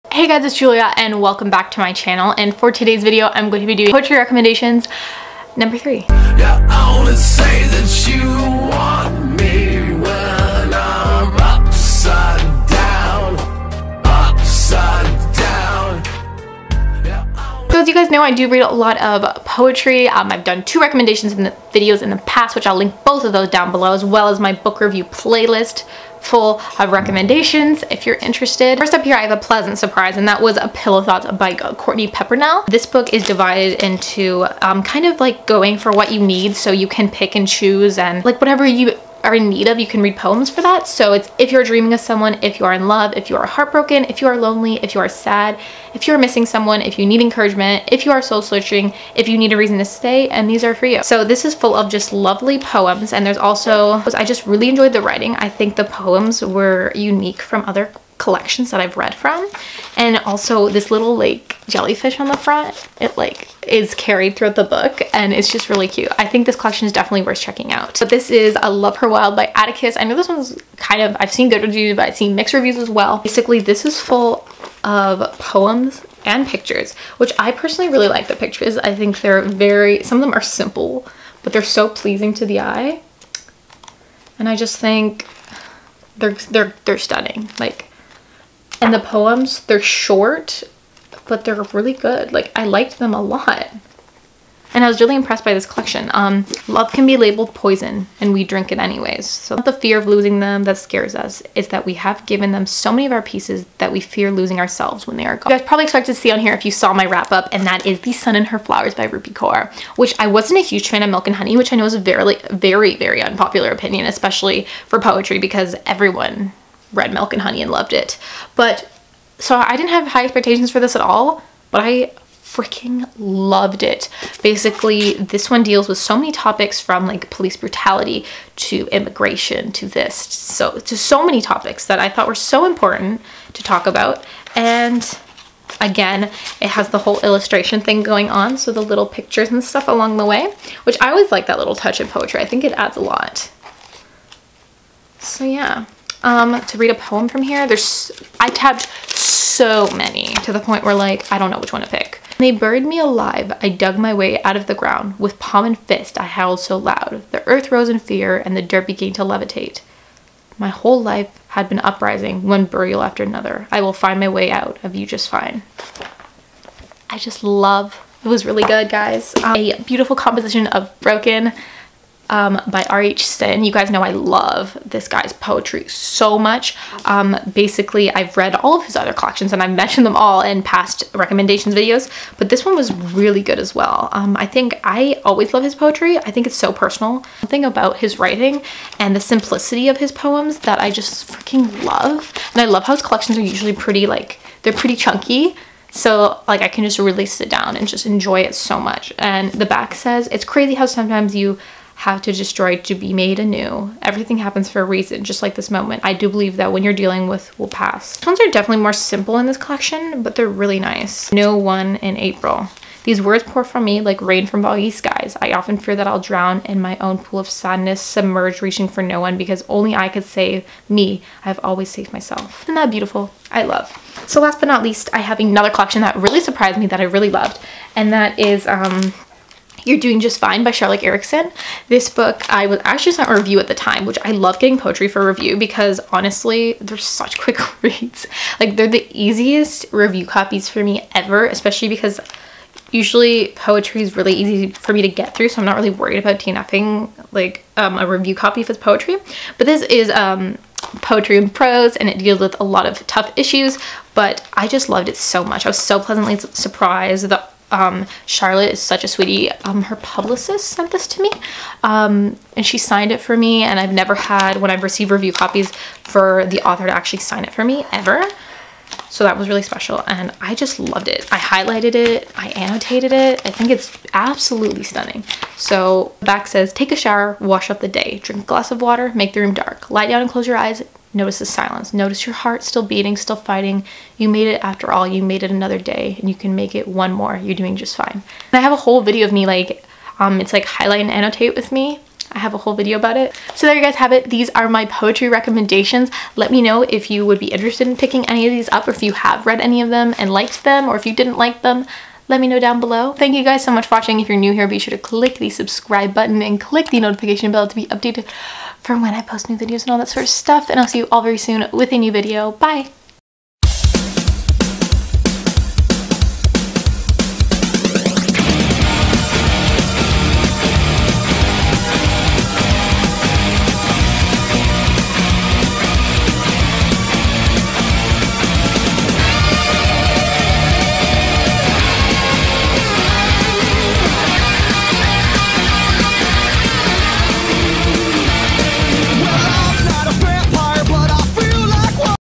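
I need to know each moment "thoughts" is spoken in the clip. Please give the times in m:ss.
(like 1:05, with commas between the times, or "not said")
0:31, 2:12.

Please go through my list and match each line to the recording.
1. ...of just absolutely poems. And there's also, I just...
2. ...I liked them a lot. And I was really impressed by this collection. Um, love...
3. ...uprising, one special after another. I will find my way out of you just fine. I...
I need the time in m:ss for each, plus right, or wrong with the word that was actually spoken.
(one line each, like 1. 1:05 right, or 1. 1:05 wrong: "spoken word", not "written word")
1. 0:51 wrong: "lovely", not "absolutely"
2. 1:32 right
3. 2:41 wrong: "burial", not "special".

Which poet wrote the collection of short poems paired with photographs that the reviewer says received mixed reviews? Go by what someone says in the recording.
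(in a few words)
Atticus.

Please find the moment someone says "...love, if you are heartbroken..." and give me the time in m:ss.
0:42.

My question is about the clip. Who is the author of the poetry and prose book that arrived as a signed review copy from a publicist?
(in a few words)
Charlotte Eriksson.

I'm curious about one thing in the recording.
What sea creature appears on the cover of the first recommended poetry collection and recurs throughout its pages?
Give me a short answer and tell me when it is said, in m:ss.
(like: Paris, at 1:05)
Jellyfish, at 1:01.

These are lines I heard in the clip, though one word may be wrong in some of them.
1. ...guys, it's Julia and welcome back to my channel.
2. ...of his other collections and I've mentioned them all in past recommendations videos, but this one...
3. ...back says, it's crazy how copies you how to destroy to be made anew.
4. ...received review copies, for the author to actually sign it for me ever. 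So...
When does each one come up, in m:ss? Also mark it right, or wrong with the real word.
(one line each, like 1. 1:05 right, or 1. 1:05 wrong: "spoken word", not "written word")
1. 0:00 right
2. 2:58 right
3. 3:19 wrong: "sometimes", not "copies"
4. 4:24 right.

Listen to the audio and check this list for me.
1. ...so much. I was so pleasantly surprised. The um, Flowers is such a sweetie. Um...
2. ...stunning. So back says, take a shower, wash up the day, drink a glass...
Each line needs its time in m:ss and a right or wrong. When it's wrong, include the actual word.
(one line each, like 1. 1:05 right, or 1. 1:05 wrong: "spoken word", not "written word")
1. 4:15 wrong: "Charlotte", not "Flowers"
2. 4:34 right.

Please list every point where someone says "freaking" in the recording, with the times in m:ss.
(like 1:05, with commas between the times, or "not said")
2:02, 3:11.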